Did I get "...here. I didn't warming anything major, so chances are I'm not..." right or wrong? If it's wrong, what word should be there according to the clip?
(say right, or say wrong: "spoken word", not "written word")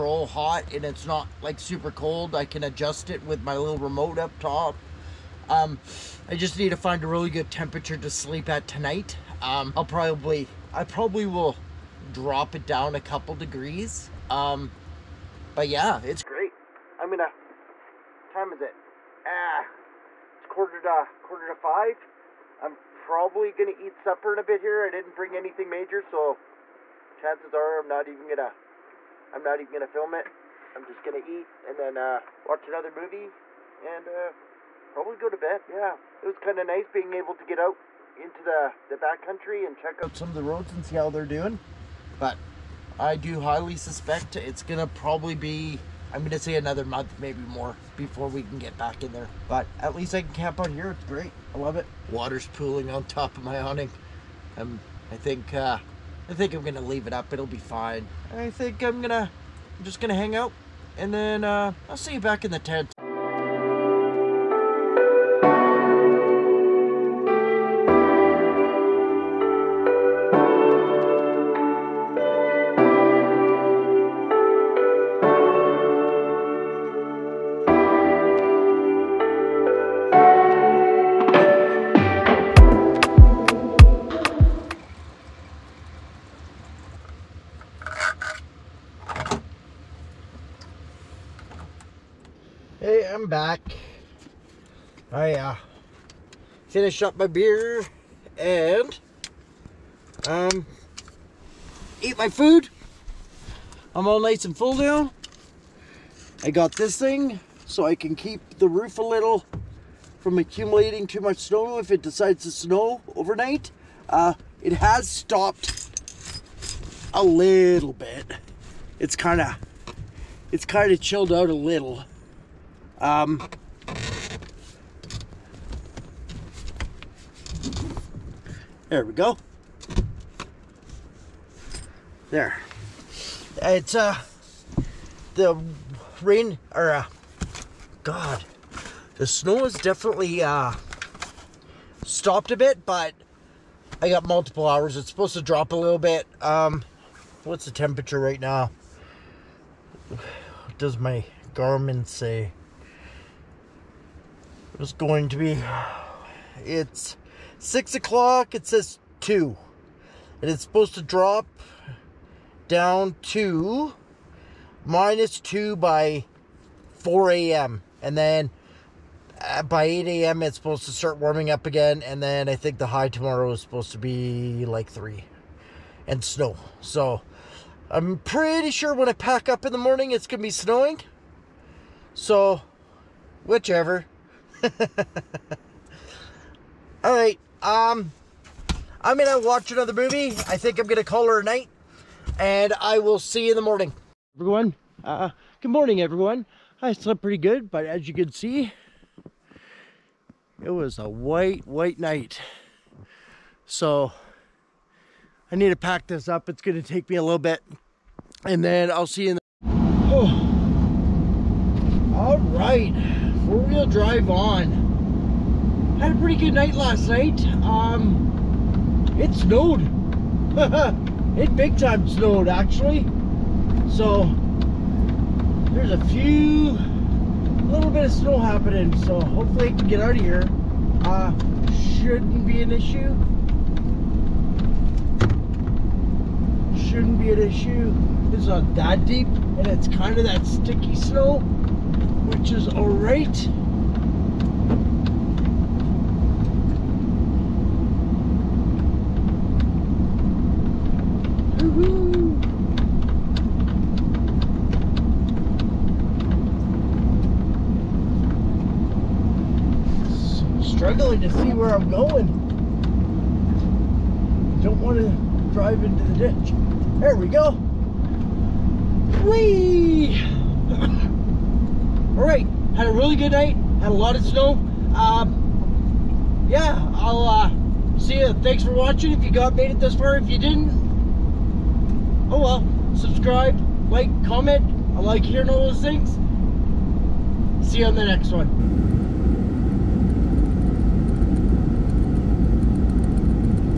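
wrong: "bring", not "warming".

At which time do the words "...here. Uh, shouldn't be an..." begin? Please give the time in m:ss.
3:50.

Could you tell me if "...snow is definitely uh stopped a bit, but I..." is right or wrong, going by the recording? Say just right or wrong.
right.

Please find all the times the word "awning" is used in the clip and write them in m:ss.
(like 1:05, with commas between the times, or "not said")
0:53.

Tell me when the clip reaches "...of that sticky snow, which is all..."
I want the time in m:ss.
4:00.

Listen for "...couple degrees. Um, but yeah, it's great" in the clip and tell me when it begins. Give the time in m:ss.
0:12.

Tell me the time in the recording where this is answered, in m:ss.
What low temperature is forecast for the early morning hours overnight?
2:44.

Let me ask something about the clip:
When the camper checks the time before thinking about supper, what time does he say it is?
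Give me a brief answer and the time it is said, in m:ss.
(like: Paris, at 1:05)
quarter to 5, at 0:21.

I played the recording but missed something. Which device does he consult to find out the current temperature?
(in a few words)
Garmin.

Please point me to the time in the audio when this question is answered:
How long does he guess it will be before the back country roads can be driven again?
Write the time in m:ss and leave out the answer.
0:46.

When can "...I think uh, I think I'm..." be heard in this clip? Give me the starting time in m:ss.
0:55.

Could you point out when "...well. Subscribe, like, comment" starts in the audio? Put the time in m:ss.
4:42.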